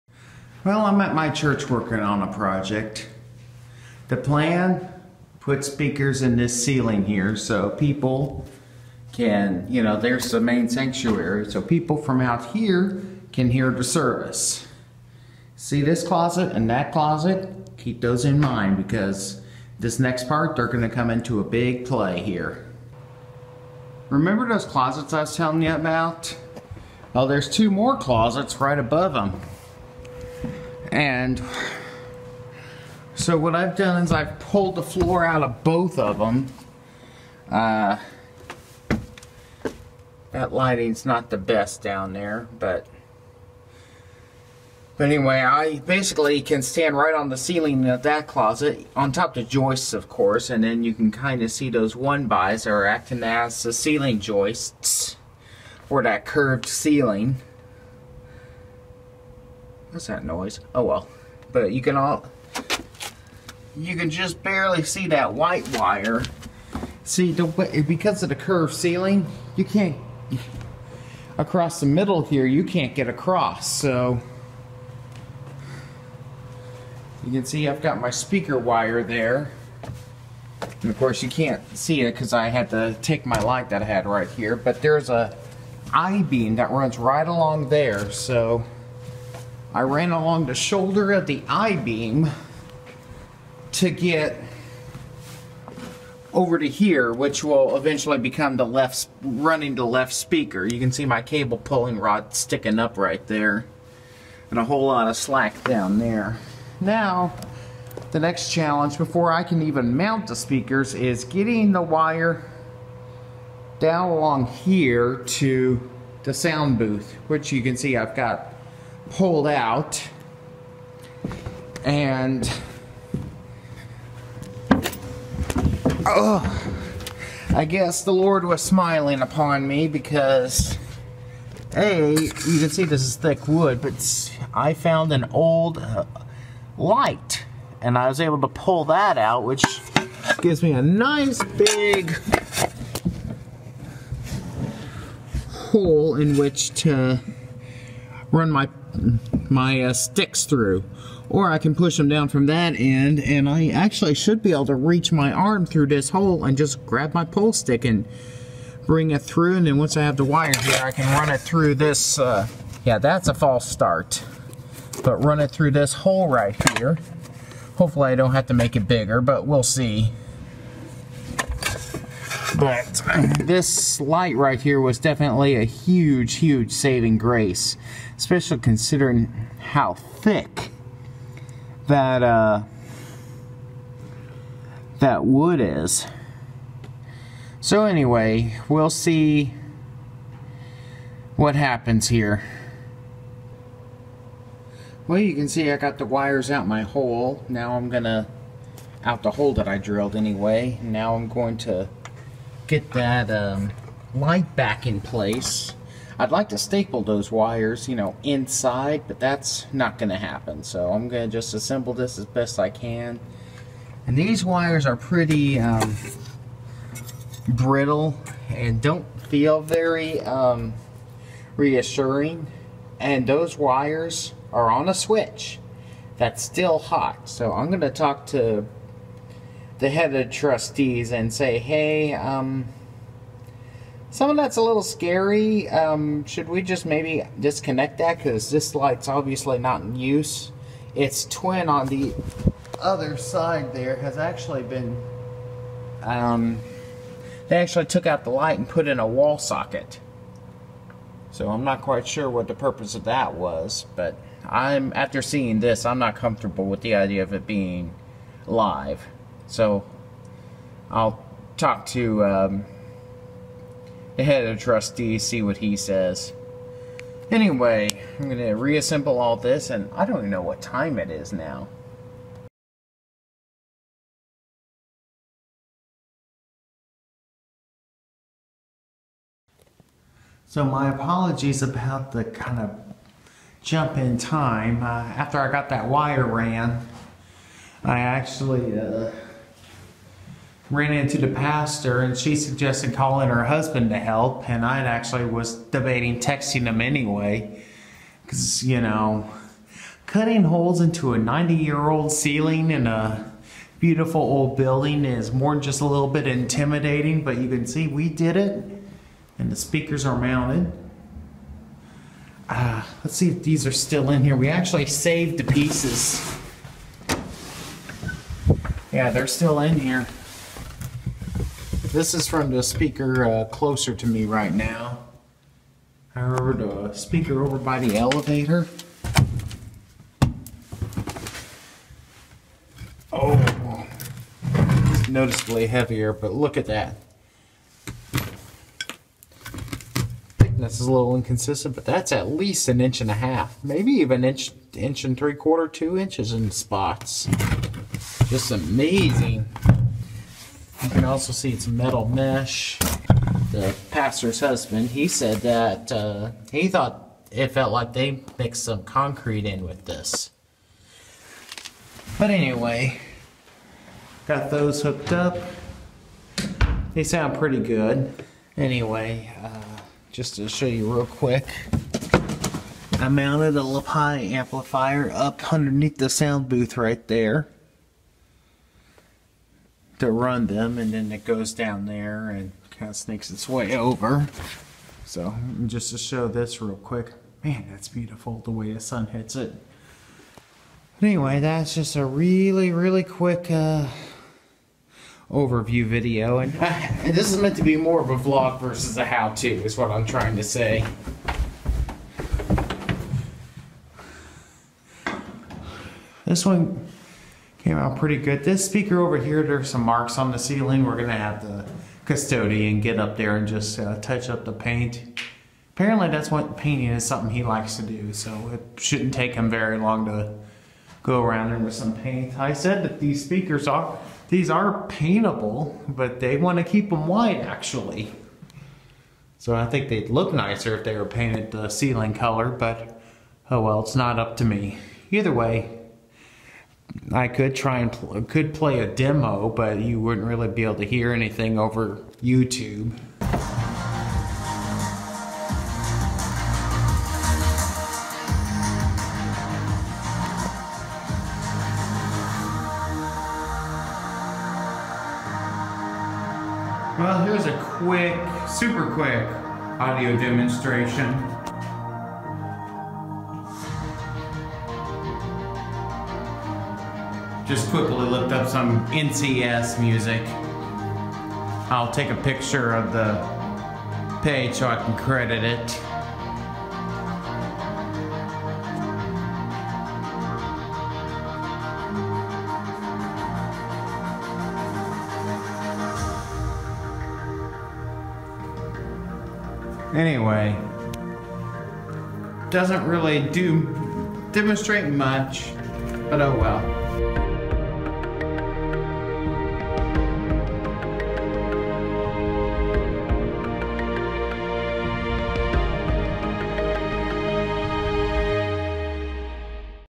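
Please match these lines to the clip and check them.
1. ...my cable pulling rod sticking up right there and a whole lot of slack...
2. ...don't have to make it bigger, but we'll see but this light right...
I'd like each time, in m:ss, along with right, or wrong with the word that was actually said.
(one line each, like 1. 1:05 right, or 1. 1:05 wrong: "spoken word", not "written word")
1. 1:41 right
2. 2:48 right.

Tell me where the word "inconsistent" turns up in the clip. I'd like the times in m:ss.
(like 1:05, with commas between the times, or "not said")
5:41.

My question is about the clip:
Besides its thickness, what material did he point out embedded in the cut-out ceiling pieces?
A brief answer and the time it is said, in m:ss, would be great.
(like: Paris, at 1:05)
Metal mesh, at 5:51.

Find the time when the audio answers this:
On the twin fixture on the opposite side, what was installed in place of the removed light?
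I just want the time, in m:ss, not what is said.
4:09.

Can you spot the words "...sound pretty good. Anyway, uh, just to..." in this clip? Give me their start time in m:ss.
6:07.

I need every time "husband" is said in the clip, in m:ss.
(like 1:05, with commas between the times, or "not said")
4:53, 5:54.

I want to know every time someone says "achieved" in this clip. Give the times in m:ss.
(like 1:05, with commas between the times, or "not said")
not said.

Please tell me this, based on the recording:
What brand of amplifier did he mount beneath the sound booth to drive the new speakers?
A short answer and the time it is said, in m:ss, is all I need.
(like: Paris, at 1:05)
Lapine, at 6:13.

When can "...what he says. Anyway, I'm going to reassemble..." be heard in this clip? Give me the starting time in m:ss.
4:25.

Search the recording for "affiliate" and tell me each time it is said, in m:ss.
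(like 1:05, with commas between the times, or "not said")
not said.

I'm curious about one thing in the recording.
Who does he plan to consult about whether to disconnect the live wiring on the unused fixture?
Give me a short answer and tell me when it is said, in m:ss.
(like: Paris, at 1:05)
Head of trustees, at 3:49.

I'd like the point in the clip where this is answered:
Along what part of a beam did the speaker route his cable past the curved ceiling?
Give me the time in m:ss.
1:30.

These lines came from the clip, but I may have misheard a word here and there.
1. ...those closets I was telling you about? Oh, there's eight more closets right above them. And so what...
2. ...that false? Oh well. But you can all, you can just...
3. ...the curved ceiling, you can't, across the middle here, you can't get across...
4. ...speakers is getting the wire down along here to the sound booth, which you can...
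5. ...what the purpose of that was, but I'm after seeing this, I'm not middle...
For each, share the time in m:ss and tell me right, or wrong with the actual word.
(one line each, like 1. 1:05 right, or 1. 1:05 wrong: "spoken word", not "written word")
1. 0:24 wrong: "two", not "eight"
2. 1:00 wrong: "noise", not "false"
3. 1:08 right
4. 1:50 right
5. 4:12 wrong: "comfortable", not "middle".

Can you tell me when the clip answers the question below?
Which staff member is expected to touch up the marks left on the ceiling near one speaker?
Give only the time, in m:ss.
6:52.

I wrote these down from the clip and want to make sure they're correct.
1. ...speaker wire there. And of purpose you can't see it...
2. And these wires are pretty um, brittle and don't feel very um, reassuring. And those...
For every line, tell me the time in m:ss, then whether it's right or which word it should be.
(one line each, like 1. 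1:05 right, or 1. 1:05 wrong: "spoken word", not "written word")
1. 1:18 wrong: "course", not "purpose"
2. 3:34 right.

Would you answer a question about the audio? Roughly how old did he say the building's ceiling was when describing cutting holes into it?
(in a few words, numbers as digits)
90 years.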